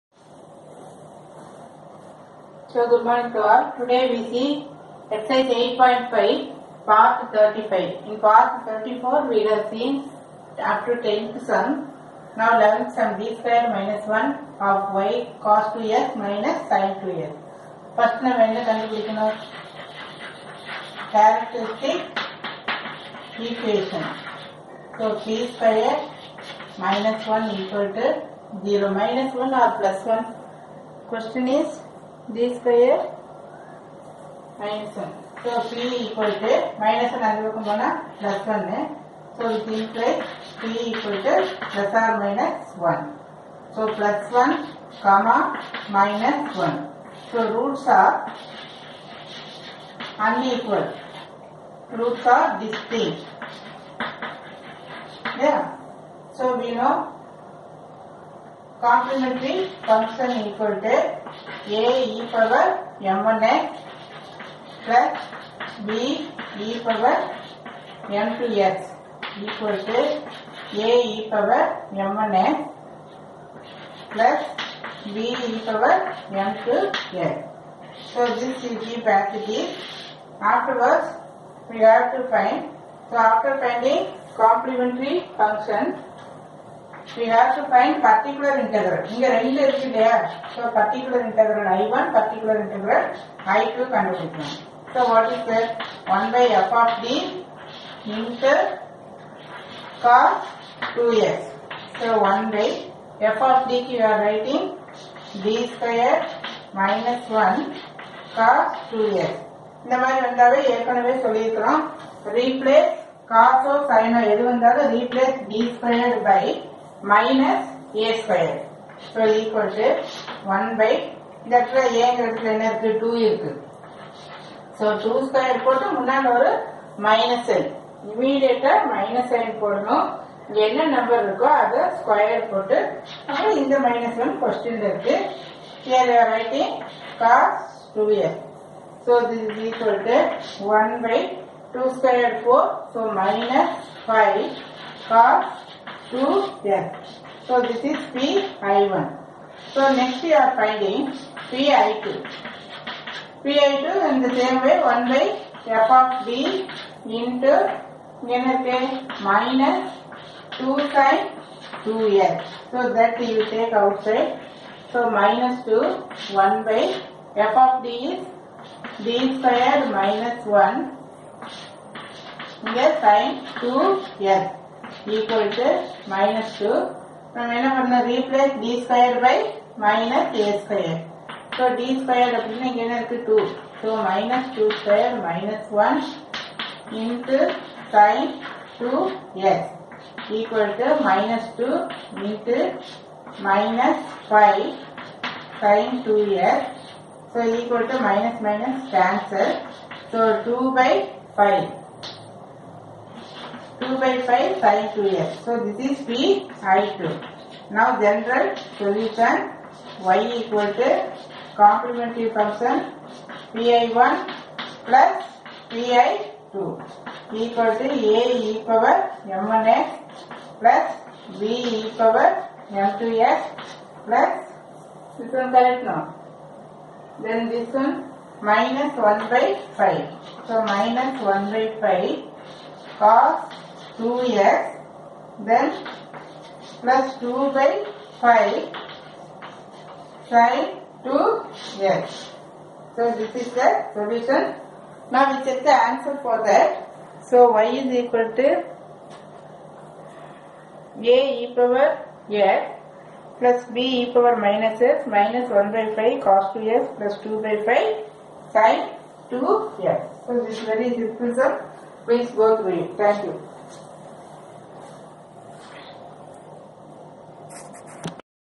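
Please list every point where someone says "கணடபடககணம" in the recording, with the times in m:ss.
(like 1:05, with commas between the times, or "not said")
0:18, 1:33.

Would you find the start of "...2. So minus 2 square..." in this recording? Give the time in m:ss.
3:03.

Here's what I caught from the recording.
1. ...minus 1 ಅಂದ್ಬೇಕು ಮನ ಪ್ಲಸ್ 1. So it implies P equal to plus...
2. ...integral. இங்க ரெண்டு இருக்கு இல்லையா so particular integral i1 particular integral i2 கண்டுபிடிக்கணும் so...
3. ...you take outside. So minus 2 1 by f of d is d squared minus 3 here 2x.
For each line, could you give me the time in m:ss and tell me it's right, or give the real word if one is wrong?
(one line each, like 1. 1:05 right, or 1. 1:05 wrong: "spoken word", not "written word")
1. 0:36 right
2. 1:28 right
3. 2:43 wrong: "1", not "3".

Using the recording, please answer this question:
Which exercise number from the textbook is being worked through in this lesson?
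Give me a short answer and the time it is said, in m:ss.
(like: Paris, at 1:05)
8.5, at 0:05.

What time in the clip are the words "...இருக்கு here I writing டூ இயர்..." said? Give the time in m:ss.
2:14.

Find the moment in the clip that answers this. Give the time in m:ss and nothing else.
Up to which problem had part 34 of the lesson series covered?
0:11.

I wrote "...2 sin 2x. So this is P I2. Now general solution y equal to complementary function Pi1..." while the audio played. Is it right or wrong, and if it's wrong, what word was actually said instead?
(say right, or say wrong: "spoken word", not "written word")
wrong: "5", not "2".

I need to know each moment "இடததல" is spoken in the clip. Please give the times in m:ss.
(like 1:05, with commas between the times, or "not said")
2:01.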